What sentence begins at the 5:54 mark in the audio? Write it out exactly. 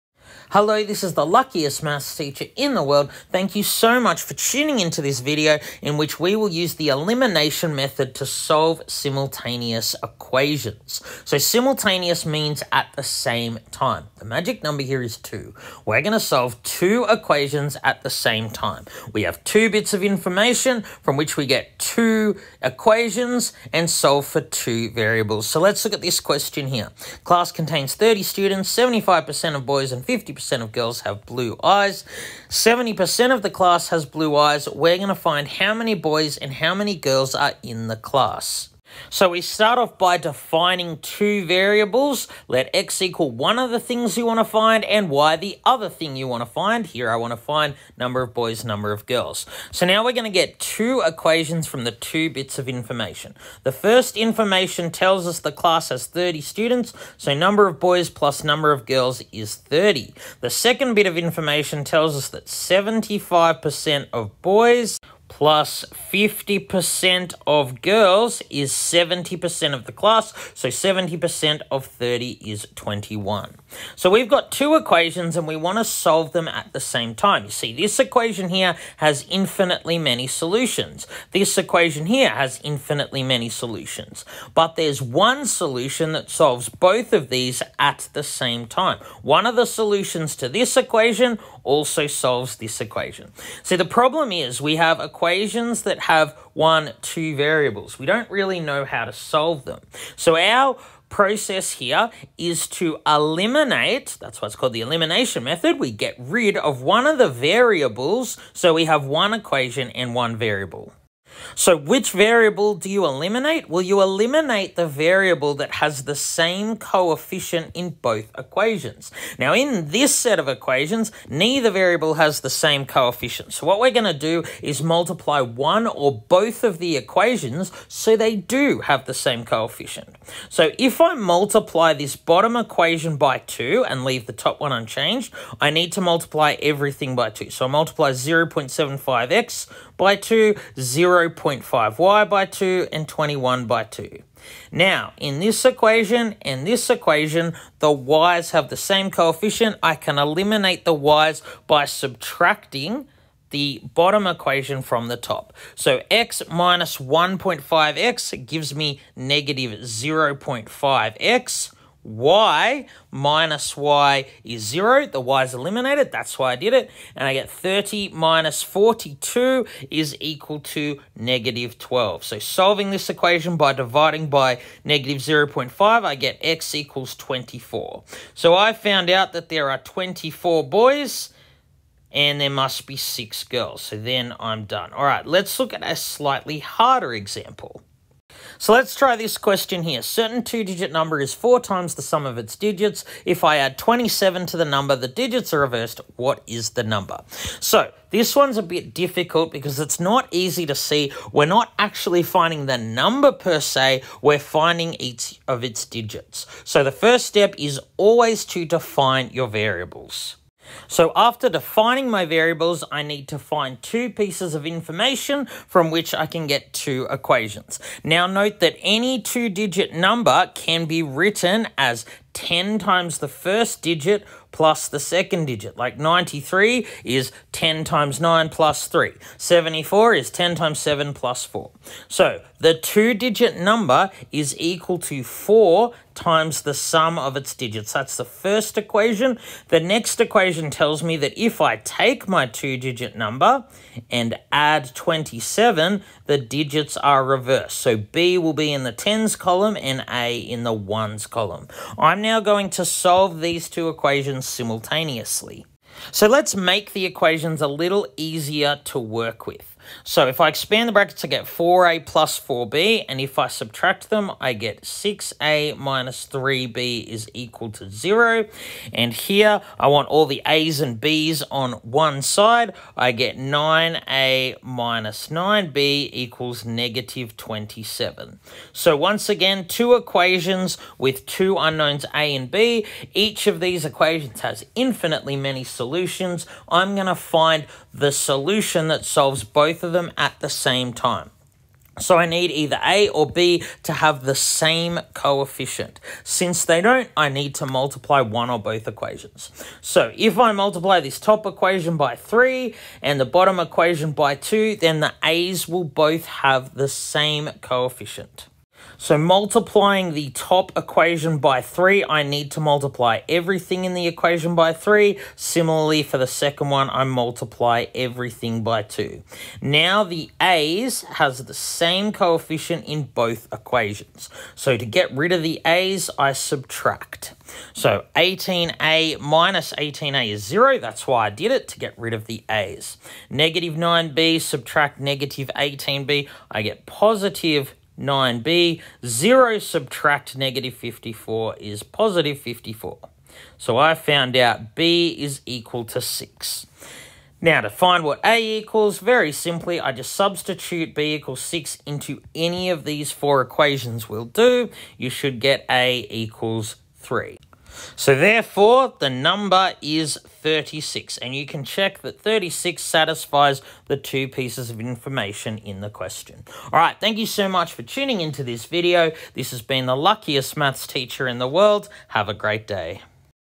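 You should get A equals 3.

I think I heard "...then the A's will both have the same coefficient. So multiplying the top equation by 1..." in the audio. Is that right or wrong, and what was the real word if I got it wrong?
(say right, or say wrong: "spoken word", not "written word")
wrong: "3", not "1".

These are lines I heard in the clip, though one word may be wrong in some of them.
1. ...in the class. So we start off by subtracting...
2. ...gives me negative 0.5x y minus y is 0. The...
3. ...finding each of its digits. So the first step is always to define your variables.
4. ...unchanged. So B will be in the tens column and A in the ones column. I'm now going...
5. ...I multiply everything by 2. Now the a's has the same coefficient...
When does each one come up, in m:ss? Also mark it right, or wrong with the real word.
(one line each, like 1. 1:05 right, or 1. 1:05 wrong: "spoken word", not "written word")
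1. 0:37 wrong: "defining", not "subtracting"
2. 2:38 right
3. 3:24 right
4. 4:07 wrong: "reversed", not "unchanged"
5. 5:16 right.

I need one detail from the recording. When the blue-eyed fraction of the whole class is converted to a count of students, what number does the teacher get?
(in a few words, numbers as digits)
21.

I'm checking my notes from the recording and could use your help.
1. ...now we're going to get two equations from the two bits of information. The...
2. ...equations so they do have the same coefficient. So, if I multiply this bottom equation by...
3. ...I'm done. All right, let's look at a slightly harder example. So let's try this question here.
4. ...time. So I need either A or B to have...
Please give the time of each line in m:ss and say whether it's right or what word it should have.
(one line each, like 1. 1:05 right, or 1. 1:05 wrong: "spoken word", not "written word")
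1. 0:49 right
2. 2:06 right
3. 3:04 right
4. 4:50 right.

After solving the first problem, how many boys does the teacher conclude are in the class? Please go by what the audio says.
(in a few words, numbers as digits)
24.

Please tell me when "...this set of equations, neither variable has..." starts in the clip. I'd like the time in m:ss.
1:59.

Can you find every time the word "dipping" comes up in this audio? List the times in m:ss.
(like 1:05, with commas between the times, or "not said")
not said.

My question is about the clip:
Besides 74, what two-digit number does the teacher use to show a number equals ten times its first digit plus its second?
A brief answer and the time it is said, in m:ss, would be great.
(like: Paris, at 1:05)
93, at 3:45.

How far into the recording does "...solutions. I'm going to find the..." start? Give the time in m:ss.
4:45.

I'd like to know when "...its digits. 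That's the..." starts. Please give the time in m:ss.
3:57.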